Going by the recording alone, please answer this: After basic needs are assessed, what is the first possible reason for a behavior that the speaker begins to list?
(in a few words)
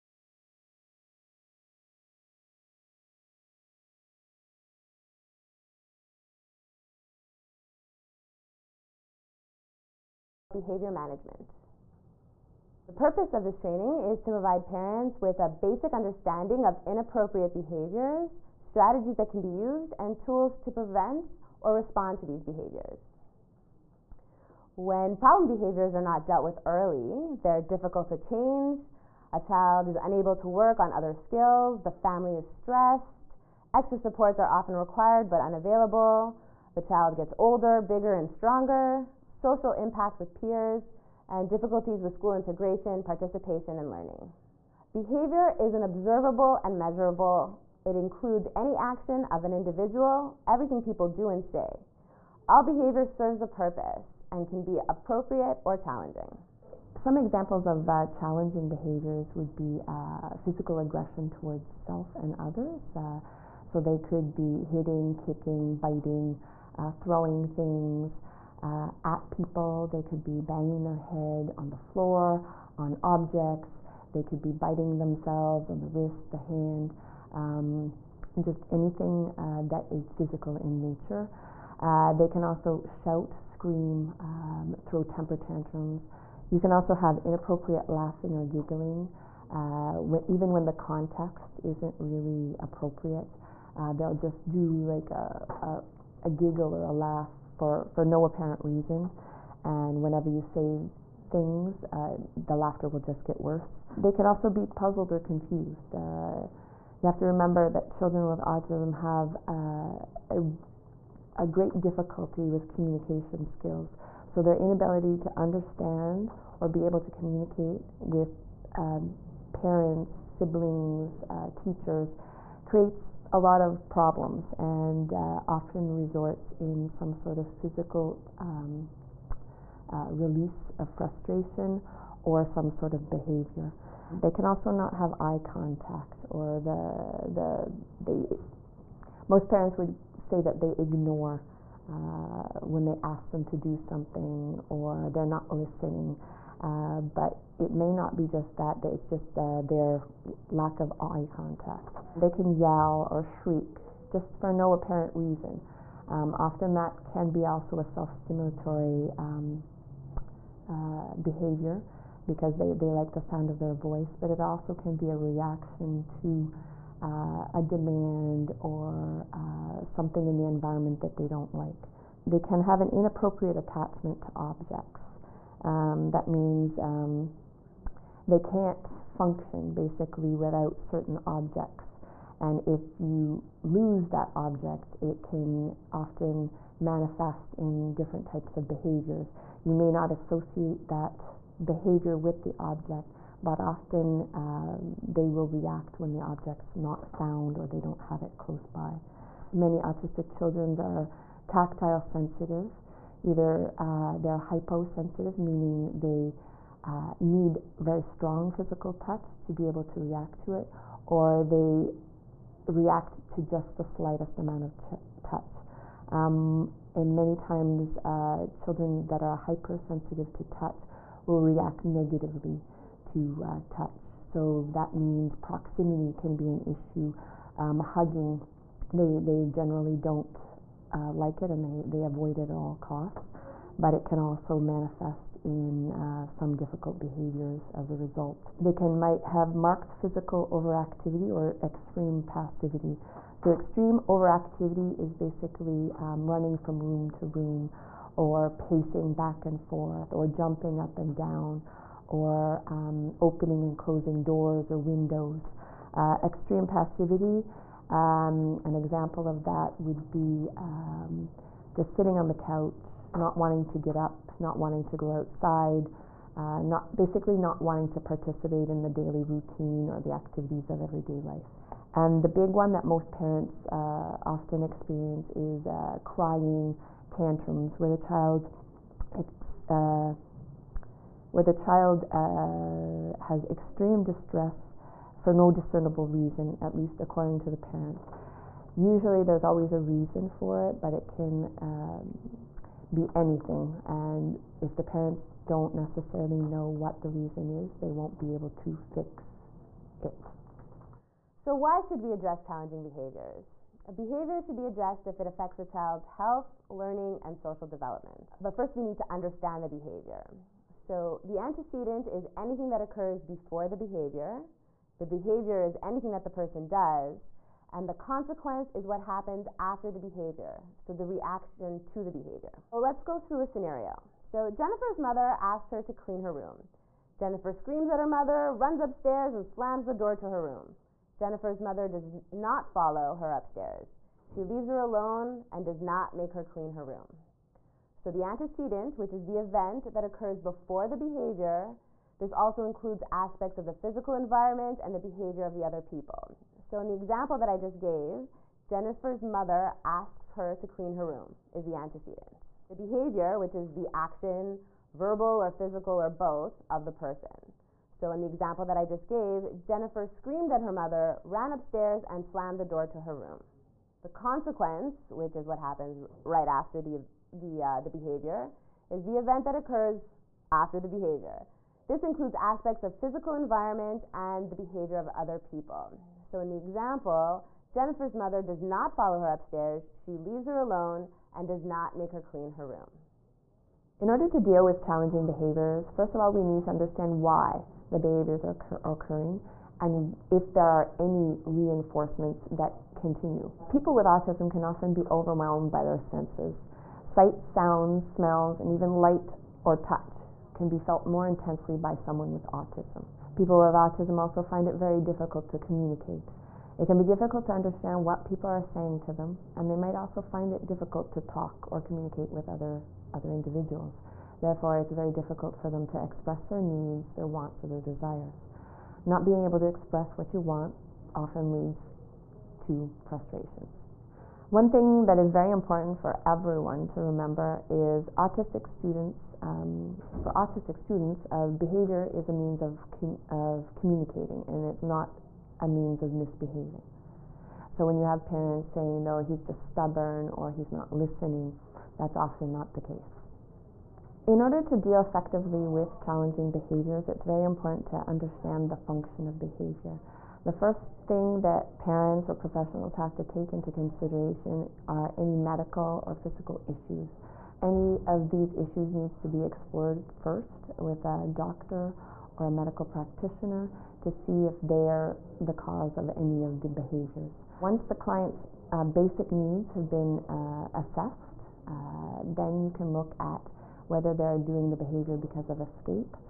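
Escape.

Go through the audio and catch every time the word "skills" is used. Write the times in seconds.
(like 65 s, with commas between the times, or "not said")
31 s, 113 s.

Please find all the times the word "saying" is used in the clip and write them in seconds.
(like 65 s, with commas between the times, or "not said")
408 s, 438 s.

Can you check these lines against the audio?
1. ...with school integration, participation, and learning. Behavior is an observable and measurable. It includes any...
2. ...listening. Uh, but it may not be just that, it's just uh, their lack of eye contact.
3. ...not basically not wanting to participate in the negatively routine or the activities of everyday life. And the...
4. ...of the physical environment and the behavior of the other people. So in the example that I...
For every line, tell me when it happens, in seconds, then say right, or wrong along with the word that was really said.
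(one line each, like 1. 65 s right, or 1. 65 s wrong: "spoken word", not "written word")
1. 42 s right
2. 145 s right
3. 266 s wrong: "daily", not "negatively"
4. 343 s right.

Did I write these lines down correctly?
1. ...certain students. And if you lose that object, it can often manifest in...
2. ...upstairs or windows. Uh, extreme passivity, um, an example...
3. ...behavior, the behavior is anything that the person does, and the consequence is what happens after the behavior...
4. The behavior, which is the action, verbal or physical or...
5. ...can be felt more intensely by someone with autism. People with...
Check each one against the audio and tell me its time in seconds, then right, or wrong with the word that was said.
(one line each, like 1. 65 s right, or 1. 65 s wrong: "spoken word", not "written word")
1. 180 s wrong: "objects", not "students"
2. 254 s wrong: "doors", not "upstairs"
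3. 313 s right
4. 352 s right
5. 400 s right.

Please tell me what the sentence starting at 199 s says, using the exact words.
Many autistic children are tactile sensitive.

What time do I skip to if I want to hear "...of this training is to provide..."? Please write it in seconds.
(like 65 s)
13 s.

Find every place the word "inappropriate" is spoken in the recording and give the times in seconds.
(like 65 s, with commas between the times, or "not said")
16 s, 87 s, 172 s.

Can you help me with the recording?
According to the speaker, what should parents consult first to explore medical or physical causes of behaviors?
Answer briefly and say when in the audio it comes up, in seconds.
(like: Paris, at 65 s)
A doctor, at 461 s.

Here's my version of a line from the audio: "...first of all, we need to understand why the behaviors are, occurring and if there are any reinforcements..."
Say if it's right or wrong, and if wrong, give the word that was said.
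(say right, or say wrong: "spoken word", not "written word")
right.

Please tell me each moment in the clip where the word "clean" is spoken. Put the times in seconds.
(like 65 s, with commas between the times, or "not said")
325 s, 336 s, 350 s, 382 s.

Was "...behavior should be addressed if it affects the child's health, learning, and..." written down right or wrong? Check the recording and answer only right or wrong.
right.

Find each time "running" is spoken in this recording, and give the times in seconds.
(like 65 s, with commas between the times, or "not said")
246 s.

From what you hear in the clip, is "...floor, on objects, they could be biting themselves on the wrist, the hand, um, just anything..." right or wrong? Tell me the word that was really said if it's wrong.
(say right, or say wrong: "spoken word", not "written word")
right.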